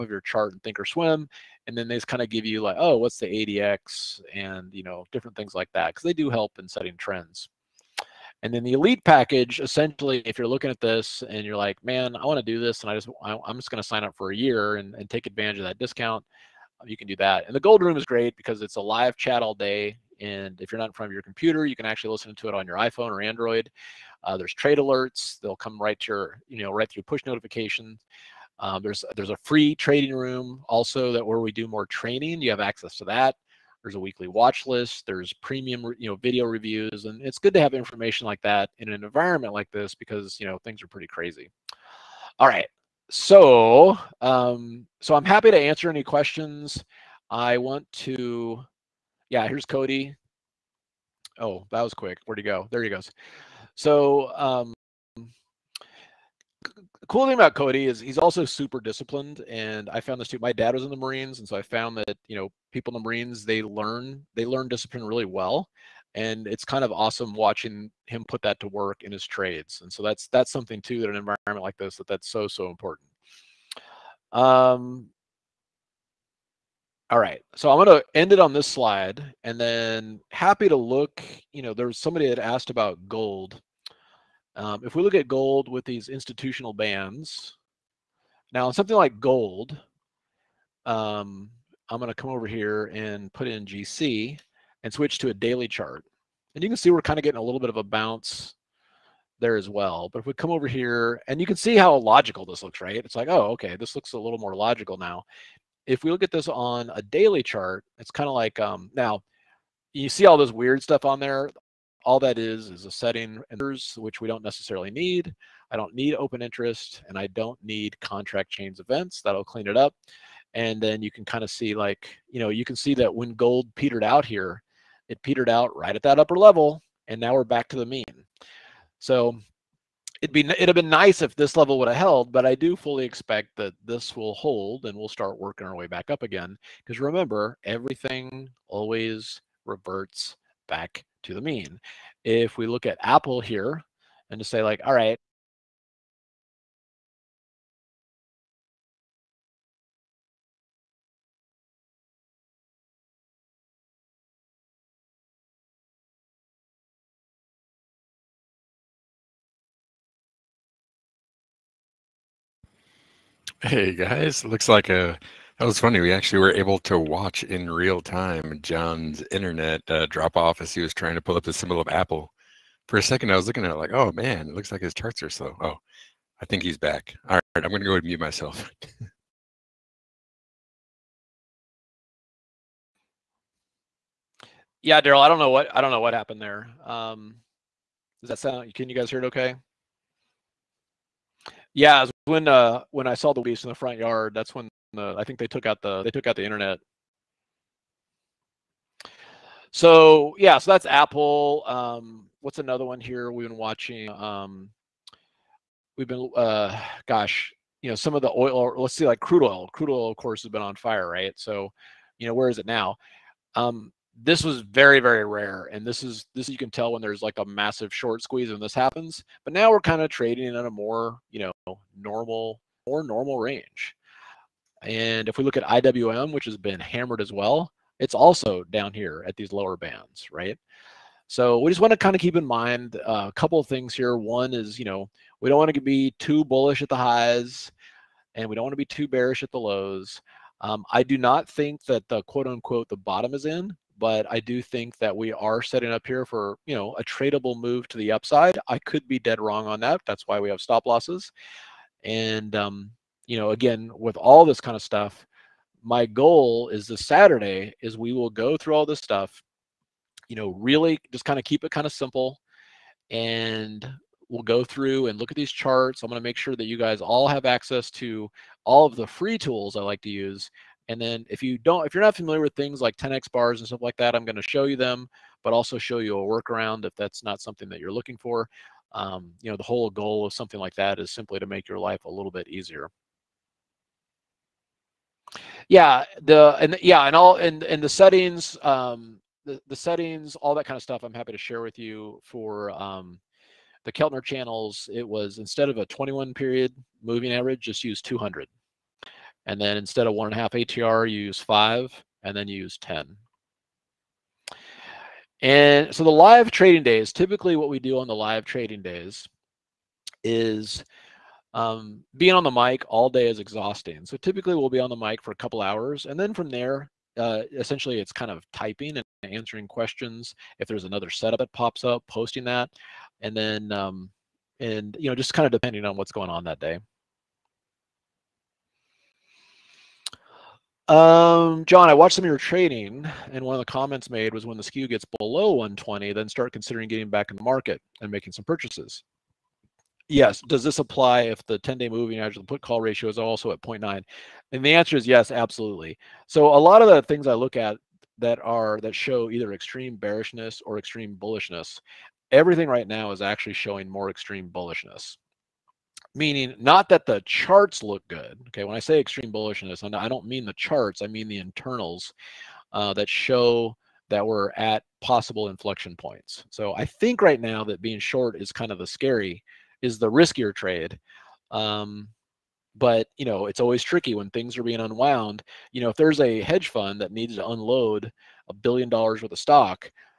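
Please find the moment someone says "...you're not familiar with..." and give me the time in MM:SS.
04:31.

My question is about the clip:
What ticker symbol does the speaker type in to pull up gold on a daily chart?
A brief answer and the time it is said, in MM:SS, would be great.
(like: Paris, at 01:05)
GC, at 01:33.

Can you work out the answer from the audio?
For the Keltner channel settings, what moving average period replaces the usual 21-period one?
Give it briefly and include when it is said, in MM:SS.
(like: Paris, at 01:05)
200, at 04:58.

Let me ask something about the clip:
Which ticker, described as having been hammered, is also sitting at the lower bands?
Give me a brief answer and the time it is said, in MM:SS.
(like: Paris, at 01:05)
IWM, at 03:45.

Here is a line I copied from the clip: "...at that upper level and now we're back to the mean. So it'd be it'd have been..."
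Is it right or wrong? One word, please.
right.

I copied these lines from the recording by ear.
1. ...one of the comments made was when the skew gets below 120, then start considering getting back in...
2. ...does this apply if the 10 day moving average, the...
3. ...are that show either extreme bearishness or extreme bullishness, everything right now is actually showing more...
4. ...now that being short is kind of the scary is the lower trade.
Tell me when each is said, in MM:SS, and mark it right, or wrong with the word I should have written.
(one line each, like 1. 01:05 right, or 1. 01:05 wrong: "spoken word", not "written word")
1. 05:33 right
2. 05:40 right
3. 05:48 right
4. 06:07 wrong: "riskier", not "lower".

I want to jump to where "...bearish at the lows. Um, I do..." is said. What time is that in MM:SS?
03:59.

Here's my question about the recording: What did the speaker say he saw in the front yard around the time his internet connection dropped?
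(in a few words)
leaves.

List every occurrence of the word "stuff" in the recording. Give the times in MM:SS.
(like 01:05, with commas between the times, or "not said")
01:50, 04:14, 04:18, 04:33, 04:50.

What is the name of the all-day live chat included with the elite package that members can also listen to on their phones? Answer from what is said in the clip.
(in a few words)
gold room.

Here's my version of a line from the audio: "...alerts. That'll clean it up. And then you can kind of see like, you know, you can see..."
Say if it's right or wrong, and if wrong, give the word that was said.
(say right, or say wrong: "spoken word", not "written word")
wrong: "events", not "alerts".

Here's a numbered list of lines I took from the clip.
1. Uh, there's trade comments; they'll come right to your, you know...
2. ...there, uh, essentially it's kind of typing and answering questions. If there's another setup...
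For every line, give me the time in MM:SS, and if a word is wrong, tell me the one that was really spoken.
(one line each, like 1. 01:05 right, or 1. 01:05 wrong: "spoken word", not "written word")
1. 00:24 wrong: "alerts", not "comments"
2. 05:16 right.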